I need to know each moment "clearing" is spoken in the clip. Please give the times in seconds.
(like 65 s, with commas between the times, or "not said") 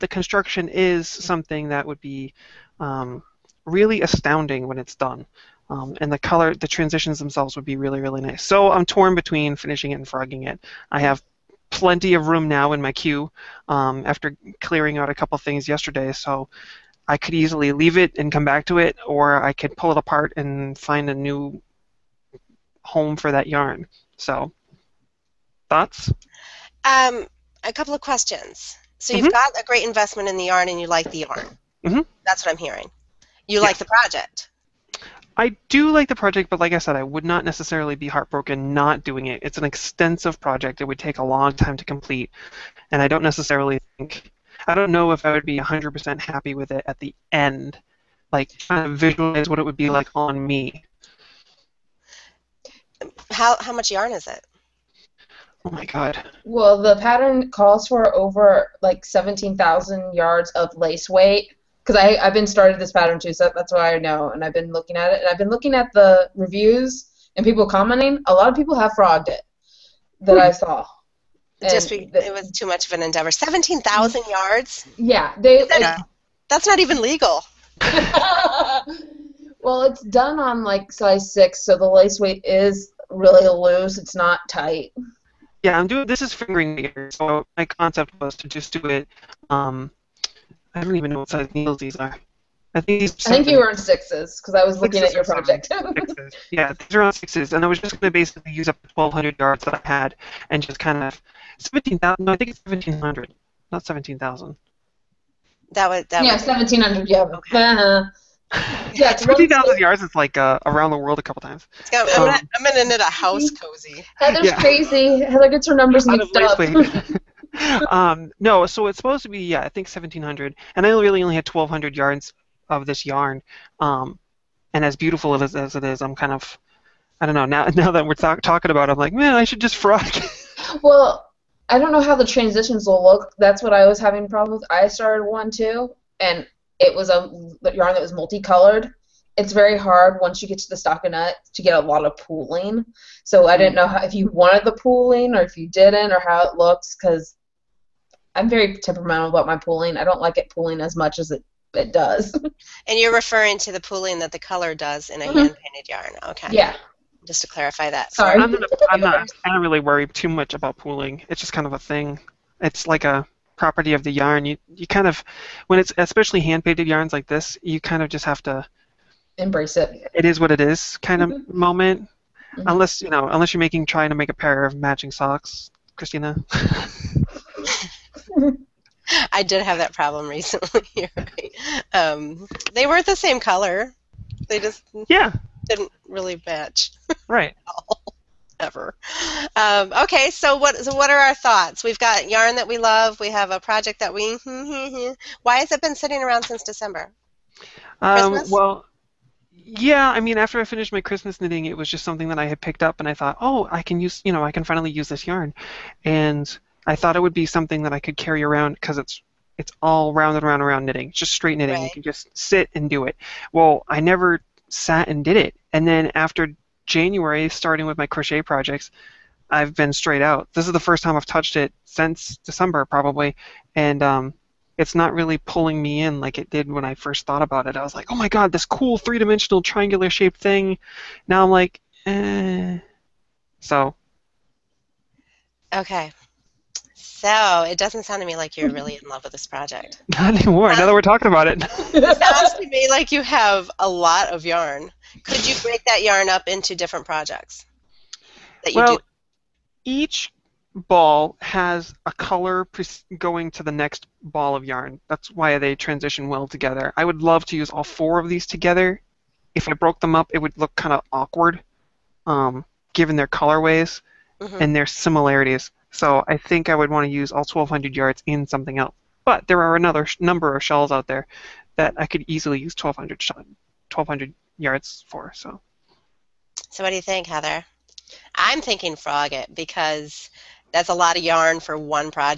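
14 s.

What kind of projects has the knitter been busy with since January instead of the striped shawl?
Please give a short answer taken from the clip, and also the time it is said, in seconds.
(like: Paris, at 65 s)
Crochet projects, at 218 s.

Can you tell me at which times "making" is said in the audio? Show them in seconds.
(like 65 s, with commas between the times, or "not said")
173 s.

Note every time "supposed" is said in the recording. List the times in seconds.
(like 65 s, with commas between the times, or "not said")
118 s.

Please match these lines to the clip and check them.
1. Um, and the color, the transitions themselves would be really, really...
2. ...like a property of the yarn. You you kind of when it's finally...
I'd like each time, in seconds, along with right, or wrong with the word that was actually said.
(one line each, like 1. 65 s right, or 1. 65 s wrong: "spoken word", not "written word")
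1. 5 s right
2. 162 s wrong: "especially", not "finally".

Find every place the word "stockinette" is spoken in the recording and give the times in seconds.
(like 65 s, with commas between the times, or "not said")
140 s.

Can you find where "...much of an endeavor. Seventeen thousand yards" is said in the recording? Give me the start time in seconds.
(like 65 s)
72 s.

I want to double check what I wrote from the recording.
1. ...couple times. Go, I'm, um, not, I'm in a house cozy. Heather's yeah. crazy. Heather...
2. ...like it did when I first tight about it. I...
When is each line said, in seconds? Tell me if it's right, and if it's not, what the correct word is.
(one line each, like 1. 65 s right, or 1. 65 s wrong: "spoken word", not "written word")
1. 111 s right
2. 226 s wrong: "thought", not "tight".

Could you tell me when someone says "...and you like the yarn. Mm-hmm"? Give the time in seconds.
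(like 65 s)
30 s.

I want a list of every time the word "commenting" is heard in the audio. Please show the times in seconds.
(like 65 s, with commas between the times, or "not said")
67 s.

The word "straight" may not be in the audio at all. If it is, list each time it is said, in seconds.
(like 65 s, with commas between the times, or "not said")
211 s, 219 s.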